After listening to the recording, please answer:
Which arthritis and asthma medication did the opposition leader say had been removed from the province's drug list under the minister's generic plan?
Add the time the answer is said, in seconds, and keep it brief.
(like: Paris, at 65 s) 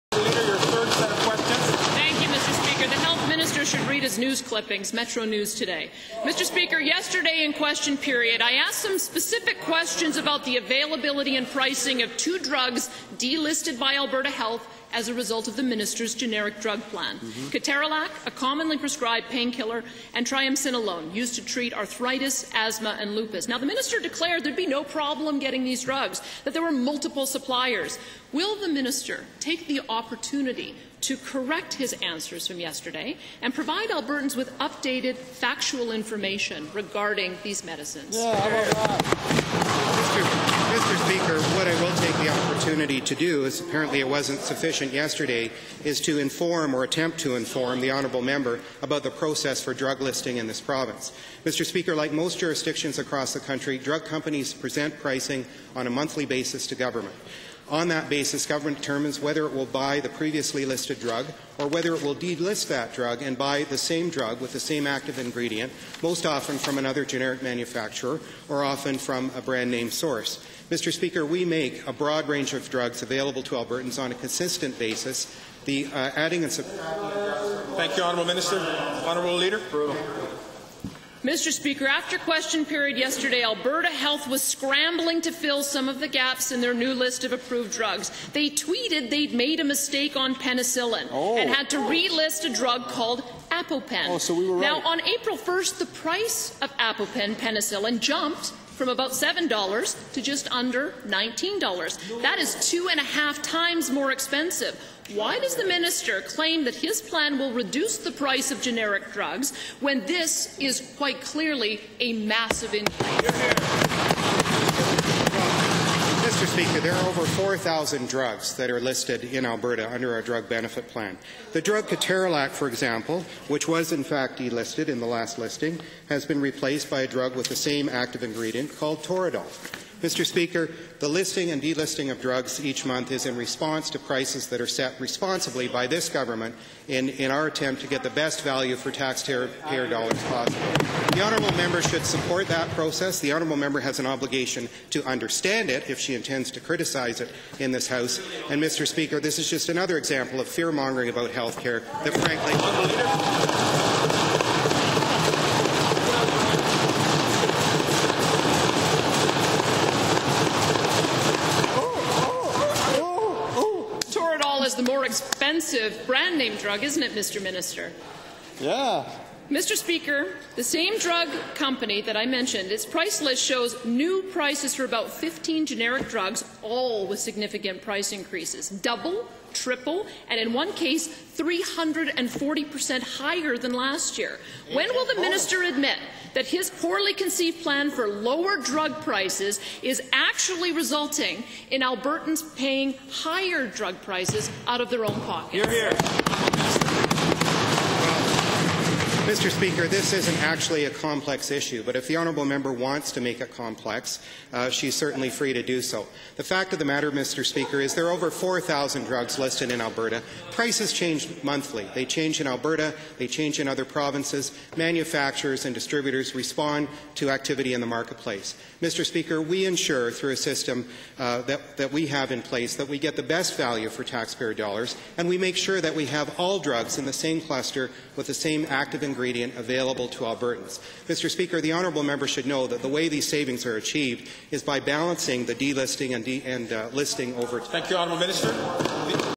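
triamcinolone, at 20 s.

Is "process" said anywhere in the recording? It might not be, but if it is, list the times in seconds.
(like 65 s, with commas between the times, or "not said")
49 s, 142 s.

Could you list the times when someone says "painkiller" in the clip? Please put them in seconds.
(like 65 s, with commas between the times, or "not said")
19 s.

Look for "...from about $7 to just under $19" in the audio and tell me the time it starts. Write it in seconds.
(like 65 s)
98 s.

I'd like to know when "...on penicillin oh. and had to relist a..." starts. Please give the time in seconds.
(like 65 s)
90 s.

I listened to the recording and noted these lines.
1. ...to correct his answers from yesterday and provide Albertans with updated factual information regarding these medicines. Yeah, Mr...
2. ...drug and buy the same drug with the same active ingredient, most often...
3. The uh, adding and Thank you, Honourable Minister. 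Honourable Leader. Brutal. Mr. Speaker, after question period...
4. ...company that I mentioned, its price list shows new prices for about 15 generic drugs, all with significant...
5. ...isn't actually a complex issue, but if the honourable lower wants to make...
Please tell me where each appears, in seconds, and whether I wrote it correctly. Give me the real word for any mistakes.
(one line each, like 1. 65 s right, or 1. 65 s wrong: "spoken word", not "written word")
1. 31 s right
2. 62 s right
3. 75 s right
4. 171 s right
5. 200 s wrong: "member", not "lower".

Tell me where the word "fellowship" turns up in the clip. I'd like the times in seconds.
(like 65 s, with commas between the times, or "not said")
not said.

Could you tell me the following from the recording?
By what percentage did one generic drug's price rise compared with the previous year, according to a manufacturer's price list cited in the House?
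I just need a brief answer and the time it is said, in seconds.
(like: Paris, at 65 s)
340%, at 181 s.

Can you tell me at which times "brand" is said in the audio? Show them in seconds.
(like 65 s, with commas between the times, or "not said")
69 s, 166 s.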